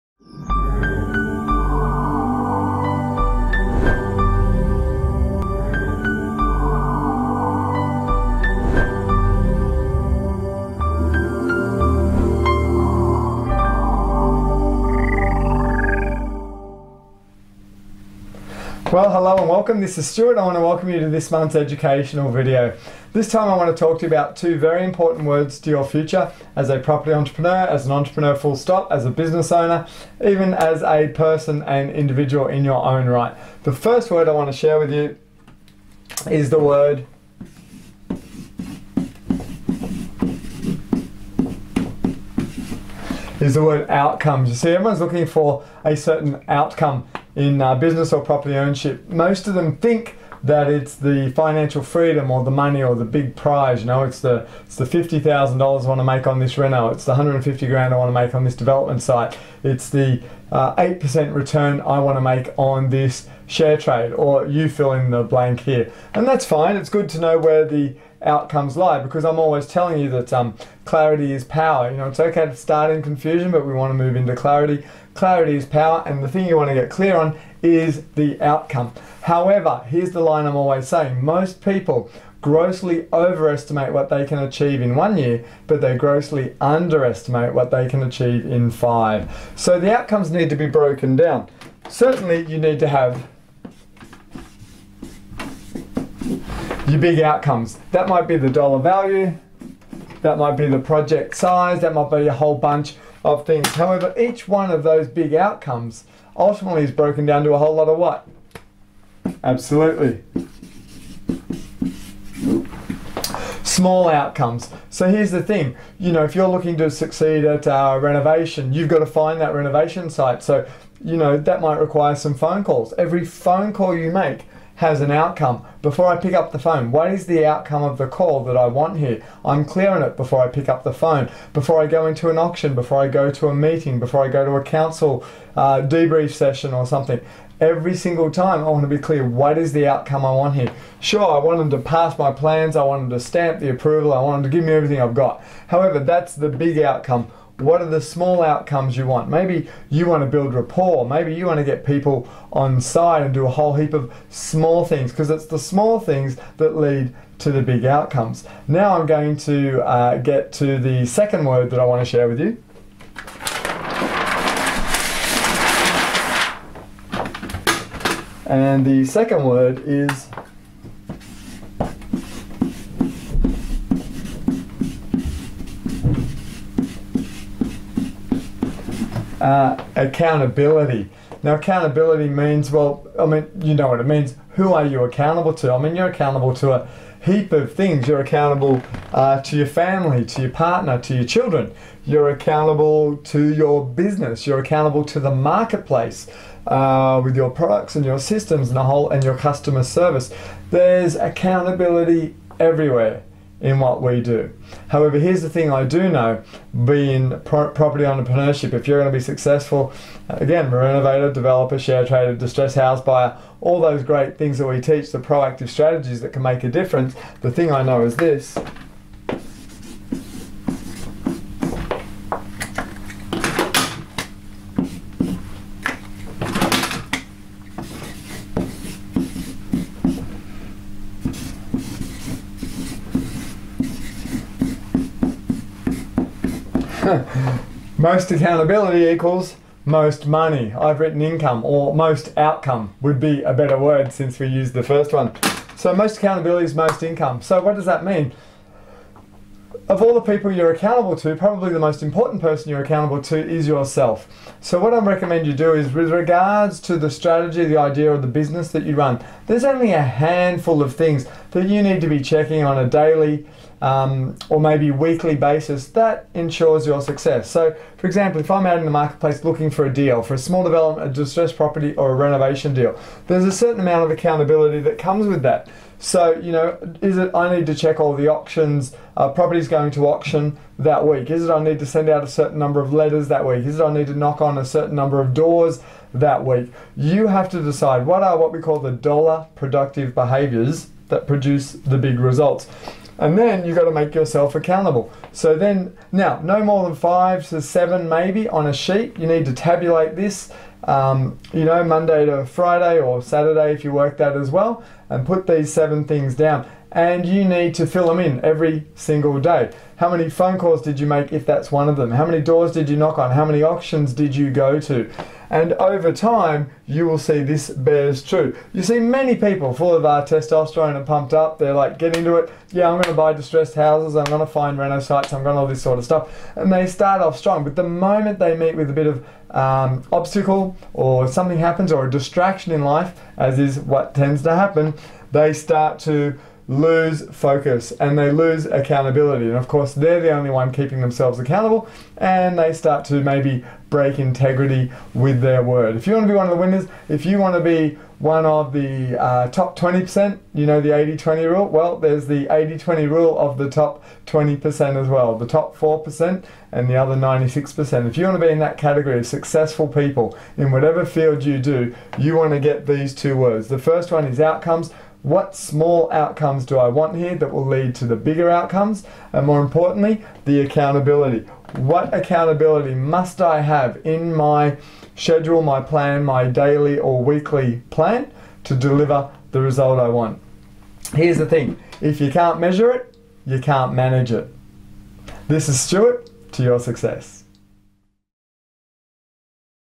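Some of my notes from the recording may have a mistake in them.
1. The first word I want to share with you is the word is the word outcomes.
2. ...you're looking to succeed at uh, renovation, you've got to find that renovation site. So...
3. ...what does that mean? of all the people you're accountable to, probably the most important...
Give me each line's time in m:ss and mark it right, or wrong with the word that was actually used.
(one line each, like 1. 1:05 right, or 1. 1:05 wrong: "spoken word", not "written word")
1. 0:33 right
2. 1:56 right
3. 4:07 right.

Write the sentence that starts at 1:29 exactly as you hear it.
So the outcomes need to be broken down.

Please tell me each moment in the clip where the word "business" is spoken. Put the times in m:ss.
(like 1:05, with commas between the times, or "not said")
0:29, 0:47, 3:13, 4:18.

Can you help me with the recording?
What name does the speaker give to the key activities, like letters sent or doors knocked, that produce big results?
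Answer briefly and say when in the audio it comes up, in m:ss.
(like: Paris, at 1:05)
Dollar productive behaviors, at 4:48.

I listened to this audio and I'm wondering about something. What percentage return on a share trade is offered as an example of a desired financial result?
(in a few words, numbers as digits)
8%.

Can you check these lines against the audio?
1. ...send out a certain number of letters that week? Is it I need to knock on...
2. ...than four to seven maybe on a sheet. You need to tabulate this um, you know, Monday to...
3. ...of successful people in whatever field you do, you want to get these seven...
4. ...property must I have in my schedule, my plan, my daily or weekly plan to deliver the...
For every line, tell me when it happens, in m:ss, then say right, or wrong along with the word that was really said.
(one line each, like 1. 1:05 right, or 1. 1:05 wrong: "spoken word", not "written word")
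1. 4:41 right
2. 4:56 wrong: "five", not "four"
3. 5:59 wrong: "two", not "seven"
4. 6:12 wrong: "accountability", not "property".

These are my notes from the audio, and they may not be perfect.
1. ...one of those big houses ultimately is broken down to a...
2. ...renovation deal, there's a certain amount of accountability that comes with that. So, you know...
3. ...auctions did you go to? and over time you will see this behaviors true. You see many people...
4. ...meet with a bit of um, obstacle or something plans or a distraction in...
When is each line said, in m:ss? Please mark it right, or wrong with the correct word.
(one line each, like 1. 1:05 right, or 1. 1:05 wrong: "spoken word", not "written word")
1. 1:44 wrong: "outcomes", not "houses"
2. 4:32 right
3. 5:13 wrong: "bears", not "behaviors"
4. 5:28 wrong: "happens", not "plans".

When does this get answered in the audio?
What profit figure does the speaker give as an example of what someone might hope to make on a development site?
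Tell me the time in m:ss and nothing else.
0:57.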